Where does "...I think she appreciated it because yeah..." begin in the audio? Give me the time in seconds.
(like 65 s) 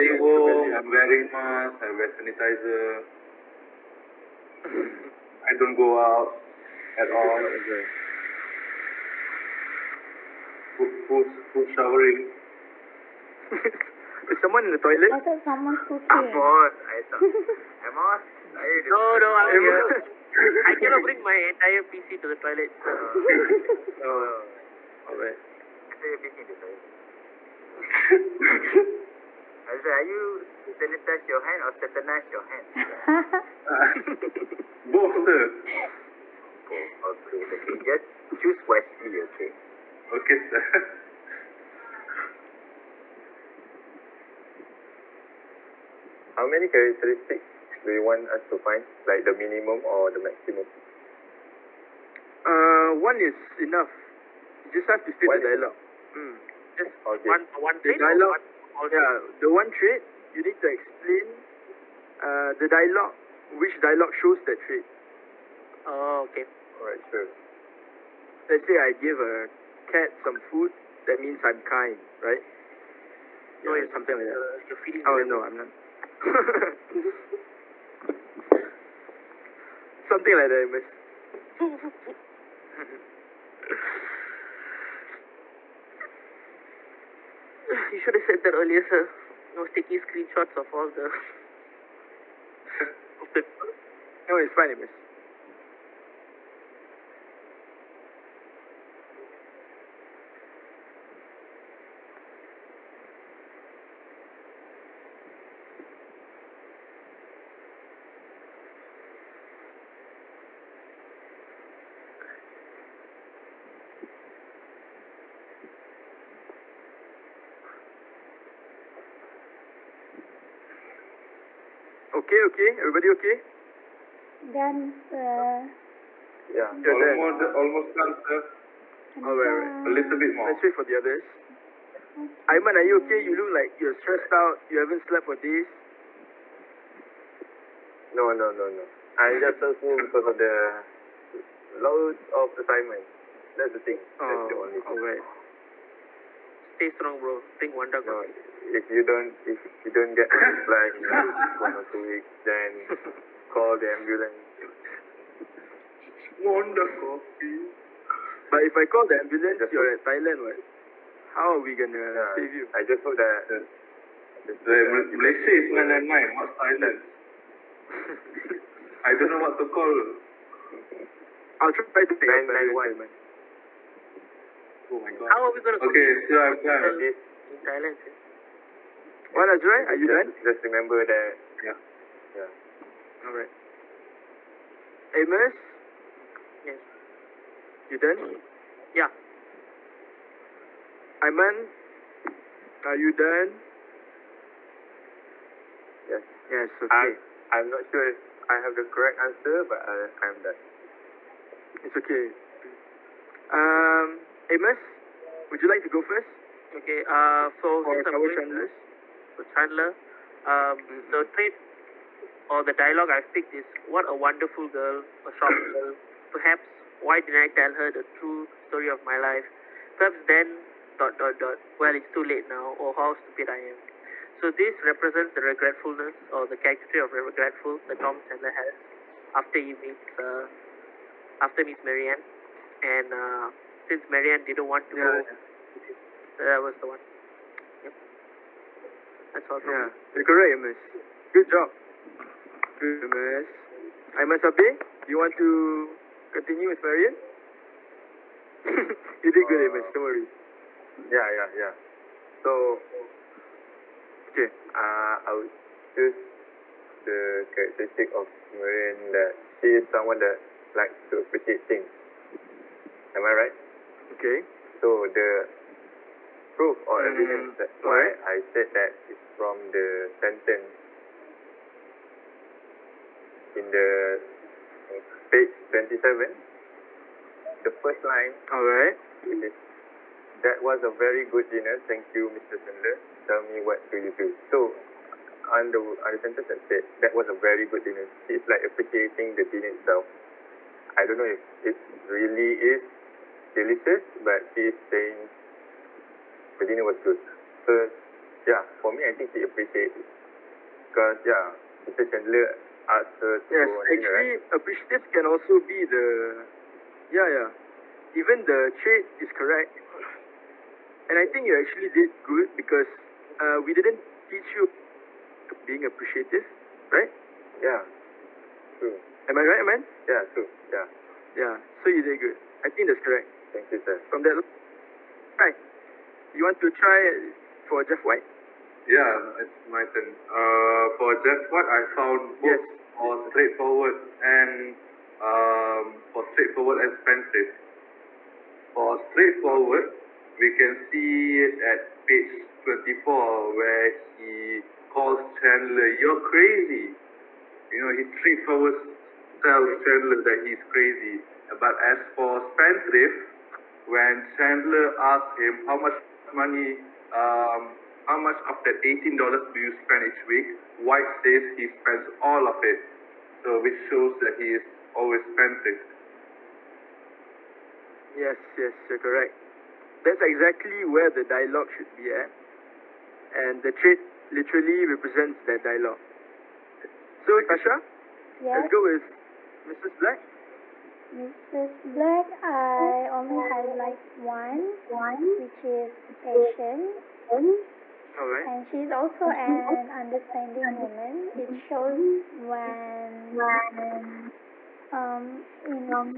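299 s.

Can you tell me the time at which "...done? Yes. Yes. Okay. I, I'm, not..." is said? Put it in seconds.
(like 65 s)
193 s.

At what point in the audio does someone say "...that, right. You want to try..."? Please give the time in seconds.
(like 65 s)
324 s.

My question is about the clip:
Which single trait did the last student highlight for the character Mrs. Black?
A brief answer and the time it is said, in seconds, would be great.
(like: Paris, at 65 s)
patient, at 386 s.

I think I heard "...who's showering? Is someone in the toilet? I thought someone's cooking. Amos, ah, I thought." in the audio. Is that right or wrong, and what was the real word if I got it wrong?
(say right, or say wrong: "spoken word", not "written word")
right.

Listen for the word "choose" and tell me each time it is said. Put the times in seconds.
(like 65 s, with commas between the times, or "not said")
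38 s, 255 s.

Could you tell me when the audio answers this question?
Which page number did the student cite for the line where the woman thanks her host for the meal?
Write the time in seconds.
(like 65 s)
275 s.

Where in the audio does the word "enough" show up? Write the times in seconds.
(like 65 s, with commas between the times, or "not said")
53 s.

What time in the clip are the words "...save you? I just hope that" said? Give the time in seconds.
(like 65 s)
162 s.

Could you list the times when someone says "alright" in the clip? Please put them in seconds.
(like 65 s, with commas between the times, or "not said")
25 s, 66 s.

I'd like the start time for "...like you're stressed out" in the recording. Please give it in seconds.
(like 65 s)
133 s.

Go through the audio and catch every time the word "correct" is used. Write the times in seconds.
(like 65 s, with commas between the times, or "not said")
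198 s, 240 s, 309 s, 322 s, 368 s.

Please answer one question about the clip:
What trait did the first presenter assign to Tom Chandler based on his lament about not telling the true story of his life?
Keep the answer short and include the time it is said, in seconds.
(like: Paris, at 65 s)
regretful, at 227 s.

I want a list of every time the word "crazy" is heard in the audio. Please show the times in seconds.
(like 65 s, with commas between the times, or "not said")
346 s, 350 s.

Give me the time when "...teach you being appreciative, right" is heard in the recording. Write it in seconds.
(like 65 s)
314 s.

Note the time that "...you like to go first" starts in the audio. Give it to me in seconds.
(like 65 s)
205 s.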